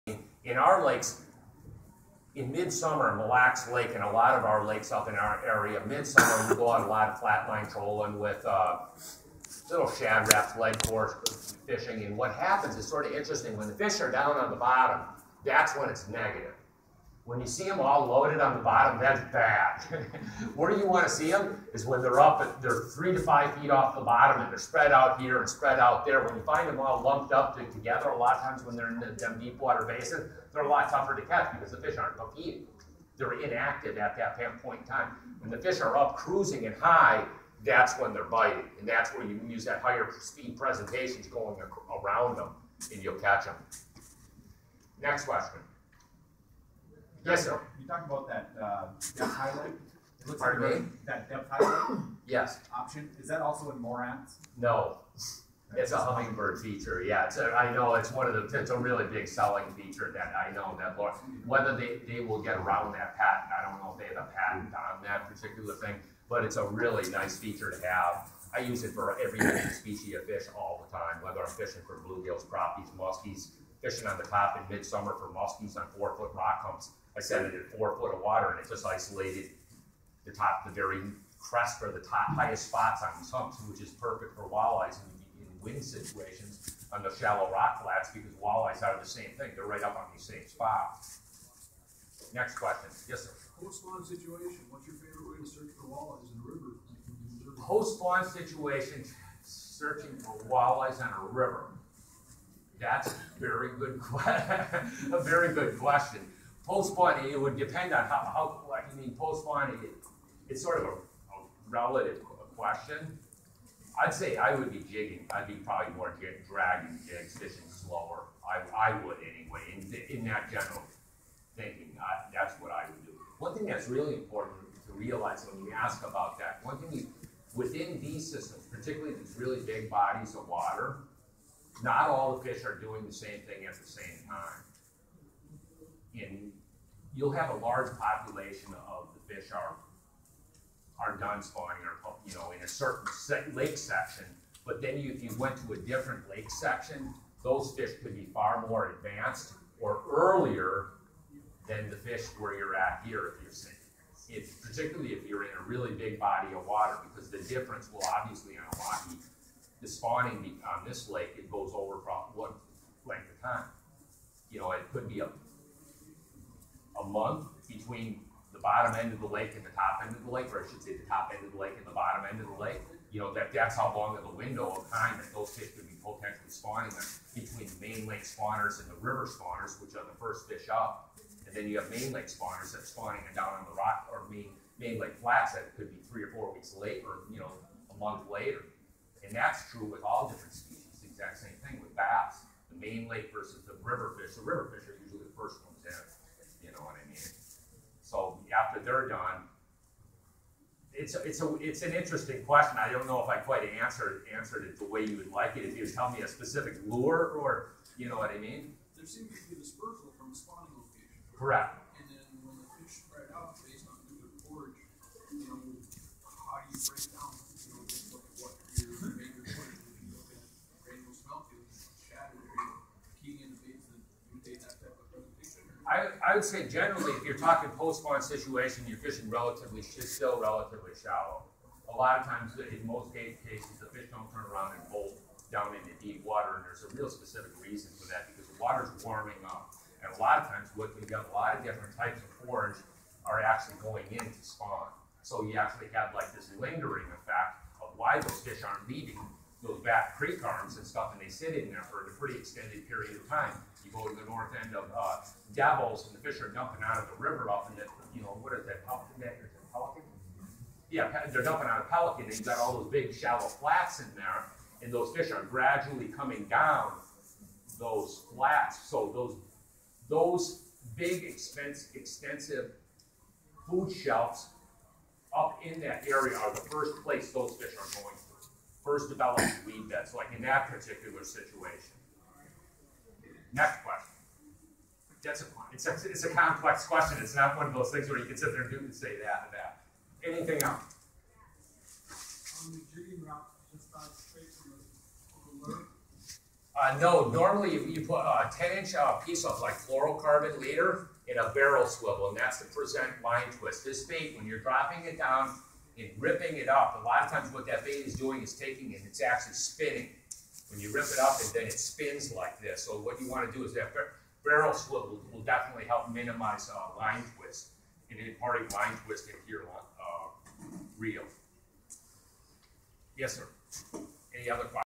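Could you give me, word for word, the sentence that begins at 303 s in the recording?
This bait, when you're dropping it down, and ripping it up.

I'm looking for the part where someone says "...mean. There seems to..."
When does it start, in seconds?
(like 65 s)
208 s.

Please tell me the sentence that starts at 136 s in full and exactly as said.
And you'll have a large population of the fish are are done spawning or you know in a certain lake section.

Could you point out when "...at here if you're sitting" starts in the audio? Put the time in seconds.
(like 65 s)
152 s.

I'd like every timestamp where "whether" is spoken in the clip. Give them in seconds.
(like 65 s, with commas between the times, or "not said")
61 s, 71 s.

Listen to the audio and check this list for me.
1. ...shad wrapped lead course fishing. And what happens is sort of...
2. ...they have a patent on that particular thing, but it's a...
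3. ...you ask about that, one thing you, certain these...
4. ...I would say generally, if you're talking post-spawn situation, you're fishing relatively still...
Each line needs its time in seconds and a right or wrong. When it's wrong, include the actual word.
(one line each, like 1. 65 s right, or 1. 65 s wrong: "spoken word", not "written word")
1. 9 s right
2. 63 s right
3. 125 s wrong: "within", not "certain"
4. 226 s right.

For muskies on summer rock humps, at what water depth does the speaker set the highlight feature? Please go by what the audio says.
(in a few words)
4 feet.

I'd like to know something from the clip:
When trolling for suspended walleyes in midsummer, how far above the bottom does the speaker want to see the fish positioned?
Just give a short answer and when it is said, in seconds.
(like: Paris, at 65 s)
3 to 5 feet, at 22 s.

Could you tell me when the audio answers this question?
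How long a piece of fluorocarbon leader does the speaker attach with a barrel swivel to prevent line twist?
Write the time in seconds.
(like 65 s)
298 s.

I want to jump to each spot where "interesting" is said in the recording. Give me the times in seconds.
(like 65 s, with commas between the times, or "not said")
13 s, 201 s.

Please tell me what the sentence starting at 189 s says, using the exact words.
And that's true with all different species.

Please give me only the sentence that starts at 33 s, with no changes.
They're inactive at that point in time.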